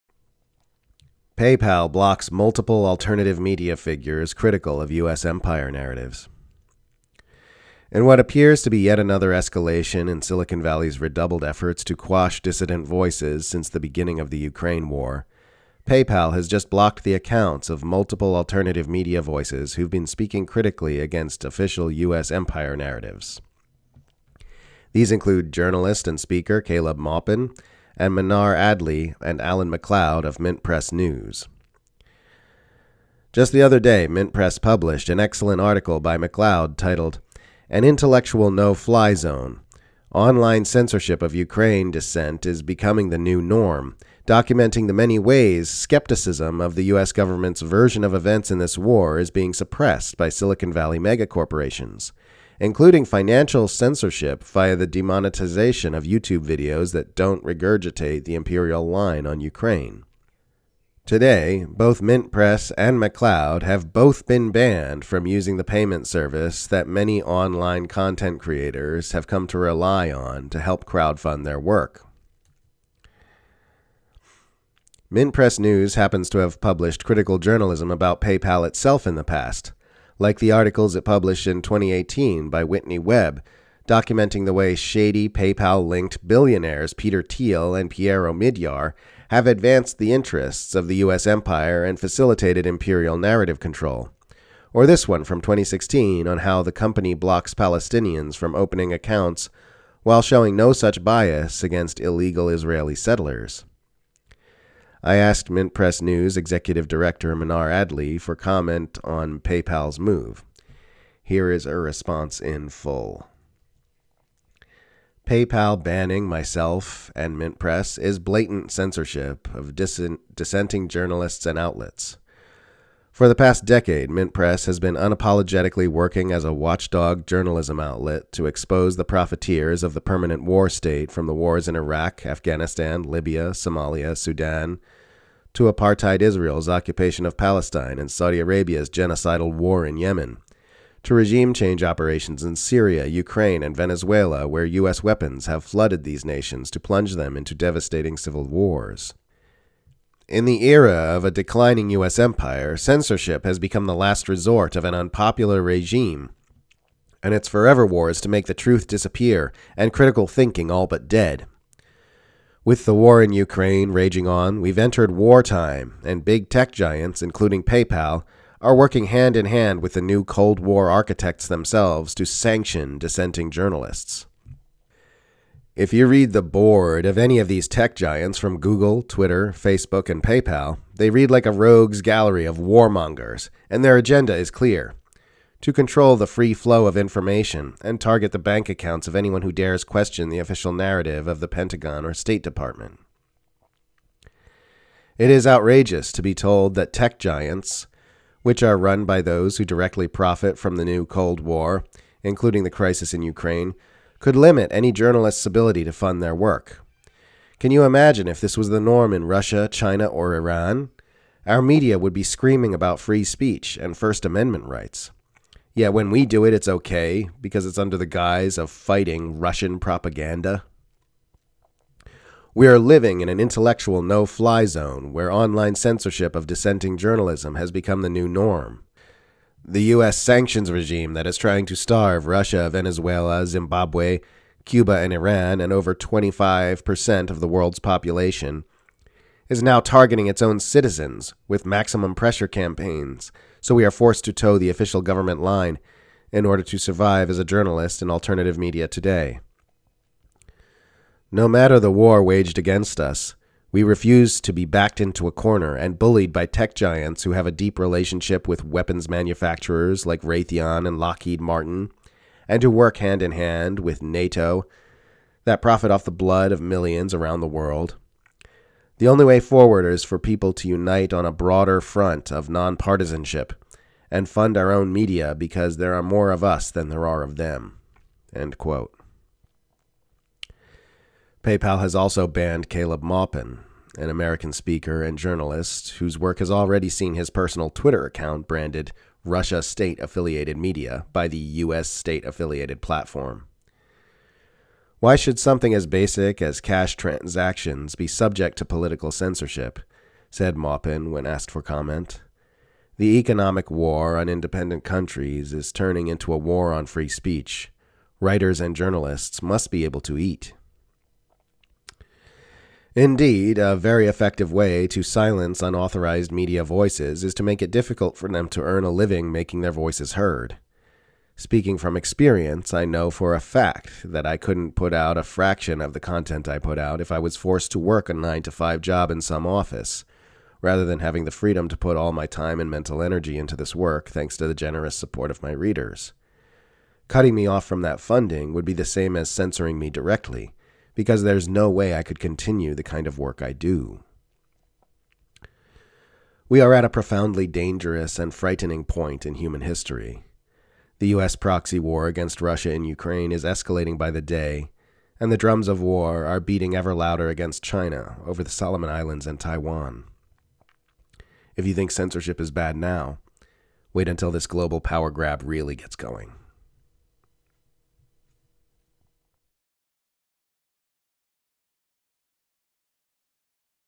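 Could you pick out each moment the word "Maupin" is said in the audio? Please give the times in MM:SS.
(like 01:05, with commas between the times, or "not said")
00:26, 04:43, 05:00.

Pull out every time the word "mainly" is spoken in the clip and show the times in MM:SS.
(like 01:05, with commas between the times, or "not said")
not said.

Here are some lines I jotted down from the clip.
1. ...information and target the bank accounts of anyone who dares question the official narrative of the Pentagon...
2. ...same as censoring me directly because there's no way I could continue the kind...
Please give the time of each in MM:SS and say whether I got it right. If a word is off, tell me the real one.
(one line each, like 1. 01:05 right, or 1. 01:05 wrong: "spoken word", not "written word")
1. 03:06 right
2. 05:38 right.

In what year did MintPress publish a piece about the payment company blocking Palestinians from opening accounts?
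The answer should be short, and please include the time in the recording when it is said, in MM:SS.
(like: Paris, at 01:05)
2016, at 01:35.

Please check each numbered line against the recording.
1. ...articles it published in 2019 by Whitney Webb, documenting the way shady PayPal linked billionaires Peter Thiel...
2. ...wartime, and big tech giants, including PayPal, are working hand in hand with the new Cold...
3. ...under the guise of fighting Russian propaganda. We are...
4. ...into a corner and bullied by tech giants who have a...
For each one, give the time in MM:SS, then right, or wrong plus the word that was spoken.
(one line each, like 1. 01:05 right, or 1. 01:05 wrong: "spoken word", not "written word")
1. 01:20 wrong: "2018", not "2019"
2. 02:45 right
3. 03:37 right
4. 04:14 right.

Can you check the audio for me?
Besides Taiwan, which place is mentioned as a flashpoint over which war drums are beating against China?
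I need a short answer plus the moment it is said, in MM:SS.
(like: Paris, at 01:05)
Solomon Islands, at 05:58.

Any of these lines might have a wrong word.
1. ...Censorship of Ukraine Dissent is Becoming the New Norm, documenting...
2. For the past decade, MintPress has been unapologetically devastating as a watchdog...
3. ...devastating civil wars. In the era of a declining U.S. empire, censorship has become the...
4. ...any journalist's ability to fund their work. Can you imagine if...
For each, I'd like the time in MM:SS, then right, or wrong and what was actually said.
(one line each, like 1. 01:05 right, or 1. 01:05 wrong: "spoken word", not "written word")
1. 00:40 right
2. 02:03 wrong: "working", not "devastating"
3. 02:27 right
4. 03:24 right.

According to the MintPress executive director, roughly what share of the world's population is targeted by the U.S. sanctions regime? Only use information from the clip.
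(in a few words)
over 25%.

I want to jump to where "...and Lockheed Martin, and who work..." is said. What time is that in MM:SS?
04:20.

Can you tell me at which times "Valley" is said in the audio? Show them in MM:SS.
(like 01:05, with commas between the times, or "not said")
00:10, 00:50.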